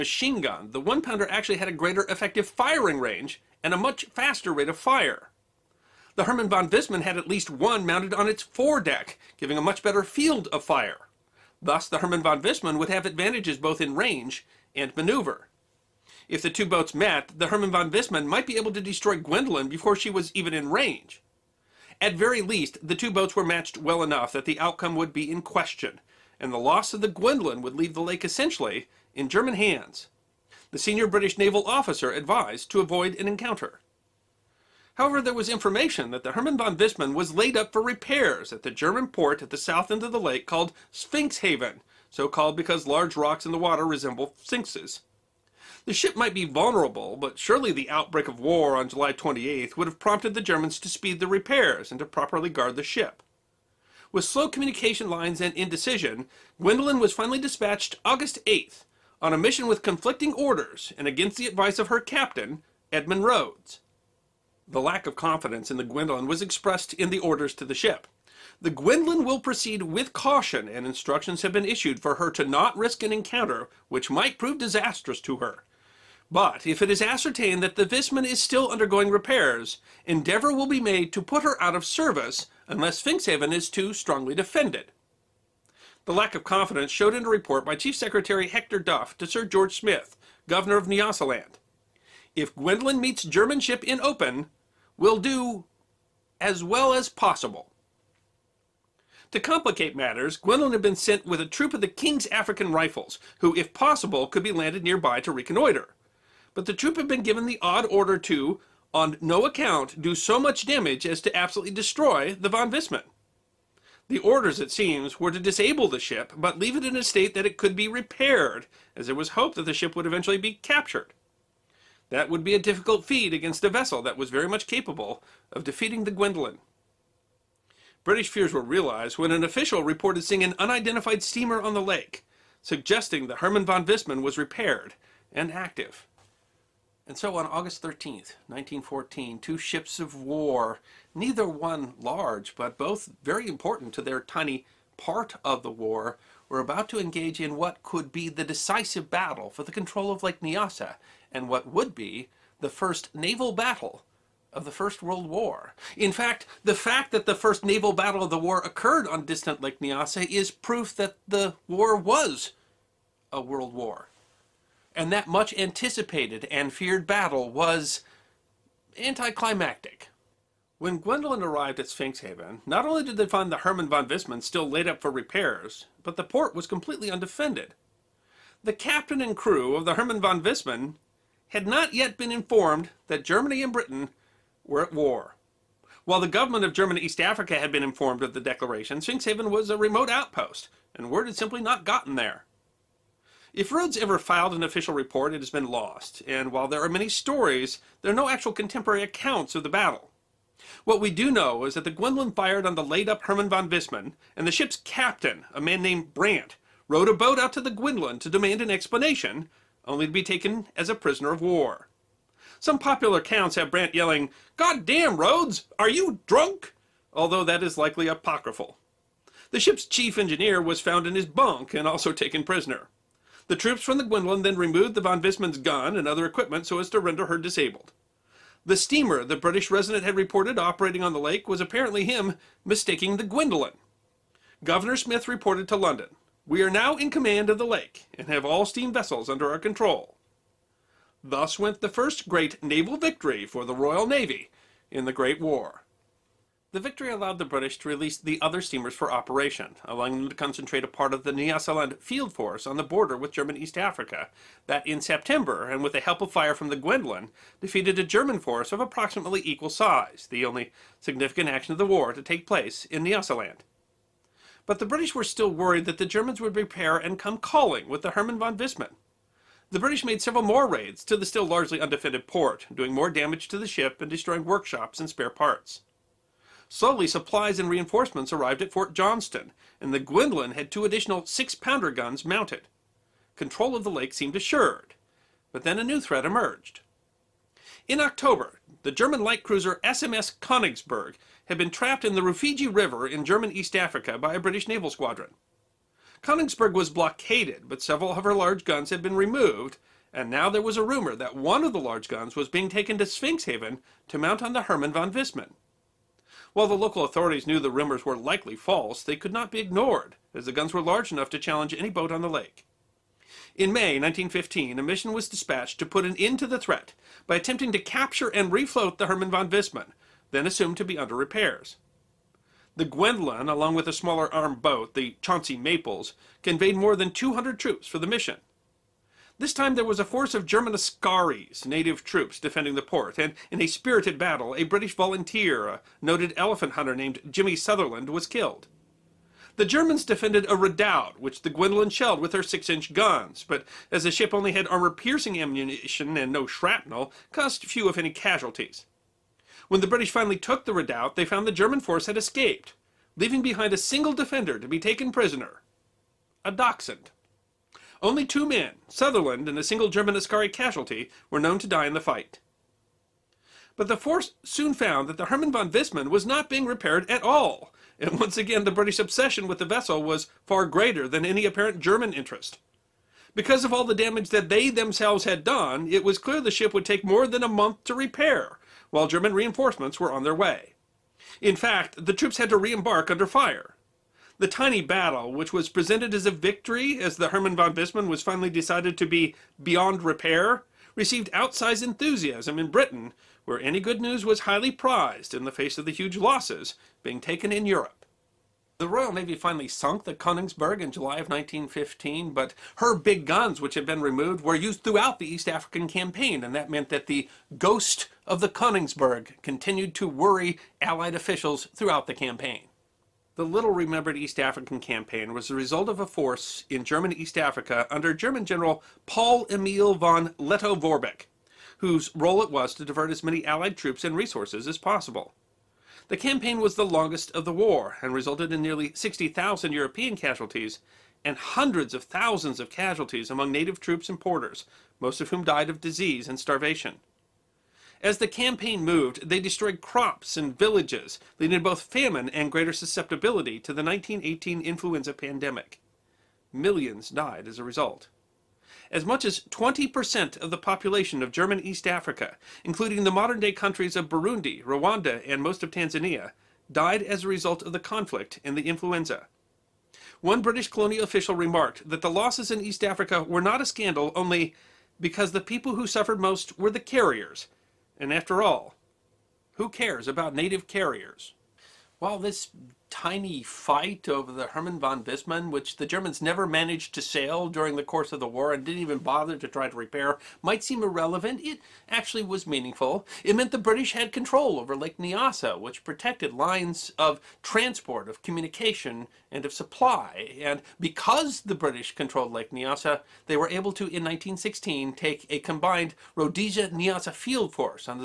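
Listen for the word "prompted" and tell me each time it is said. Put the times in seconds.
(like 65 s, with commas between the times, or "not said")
49 s.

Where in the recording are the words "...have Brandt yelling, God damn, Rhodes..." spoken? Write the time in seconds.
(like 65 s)
213 s.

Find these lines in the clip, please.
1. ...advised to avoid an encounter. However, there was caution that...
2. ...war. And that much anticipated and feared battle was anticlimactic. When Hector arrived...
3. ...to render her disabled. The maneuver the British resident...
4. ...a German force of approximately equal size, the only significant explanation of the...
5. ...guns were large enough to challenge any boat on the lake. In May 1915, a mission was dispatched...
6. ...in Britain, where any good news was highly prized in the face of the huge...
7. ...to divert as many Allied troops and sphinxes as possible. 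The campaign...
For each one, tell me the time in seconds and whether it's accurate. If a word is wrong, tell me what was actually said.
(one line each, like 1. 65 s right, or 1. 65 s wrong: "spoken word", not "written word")
1. 32 s wrong: "information", not "caution"
2. 163 s wrong: "Gwendolyn", not "Hector"
3. 226 s wrong: "steamer", not "maneuver"
4. 257 s wrong: "action", not "explanation"
5. 310 s right
6. 392 s right
7. 422 s wrong: "resources", not "sphinxes".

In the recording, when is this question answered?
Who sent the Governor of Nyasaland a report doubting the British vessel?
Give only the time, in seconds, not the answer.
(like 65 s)
88 s.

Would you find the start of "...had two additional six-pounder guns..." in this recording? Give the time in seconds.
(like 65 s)
280 s.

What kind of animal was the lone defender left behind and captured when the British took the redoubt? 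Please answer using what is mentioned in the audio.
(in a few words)
a dachshund.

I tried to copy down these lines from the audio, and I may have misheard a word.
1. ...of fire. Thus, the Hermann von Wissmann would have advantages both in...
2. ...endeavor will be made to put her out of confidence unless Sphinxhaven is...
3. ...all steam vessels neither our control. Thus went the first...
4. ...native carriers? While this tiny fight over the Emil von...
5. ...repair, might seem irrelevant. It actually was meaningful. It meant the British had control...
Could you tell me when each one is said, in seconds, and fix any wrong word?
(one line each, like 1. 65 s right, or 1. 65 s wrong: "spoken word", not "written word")
1. 10 s right
2. 80 s wrong: "service", not "confidence"
3. 238 s wrong: "under", not "neither"
4. 470 s wrong: "Hermann", not "Emil"
5. 479 s right.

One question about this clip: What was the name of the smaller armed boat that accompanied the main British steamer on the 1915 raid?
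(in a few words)
Chauncey Maples.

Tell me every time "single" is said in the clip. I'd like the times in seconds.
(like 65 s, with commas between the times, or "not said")
353 s, 359 s.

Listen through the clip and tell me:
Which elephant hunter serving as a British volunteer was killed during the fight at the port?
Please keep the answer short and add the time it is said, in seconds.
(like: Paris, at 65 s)
Jimmy Sutherland, at 337 s.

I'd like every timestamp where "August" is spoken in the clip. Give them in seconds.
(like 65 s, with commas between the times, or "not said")
58 s, 137 s.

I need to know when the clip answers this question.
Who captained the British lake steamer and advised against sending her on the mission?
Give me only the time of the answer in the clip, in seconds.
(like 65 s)
62 s.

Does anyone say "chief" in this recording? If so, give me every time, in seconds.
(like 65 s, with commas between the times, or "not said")
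87 s, 219 s.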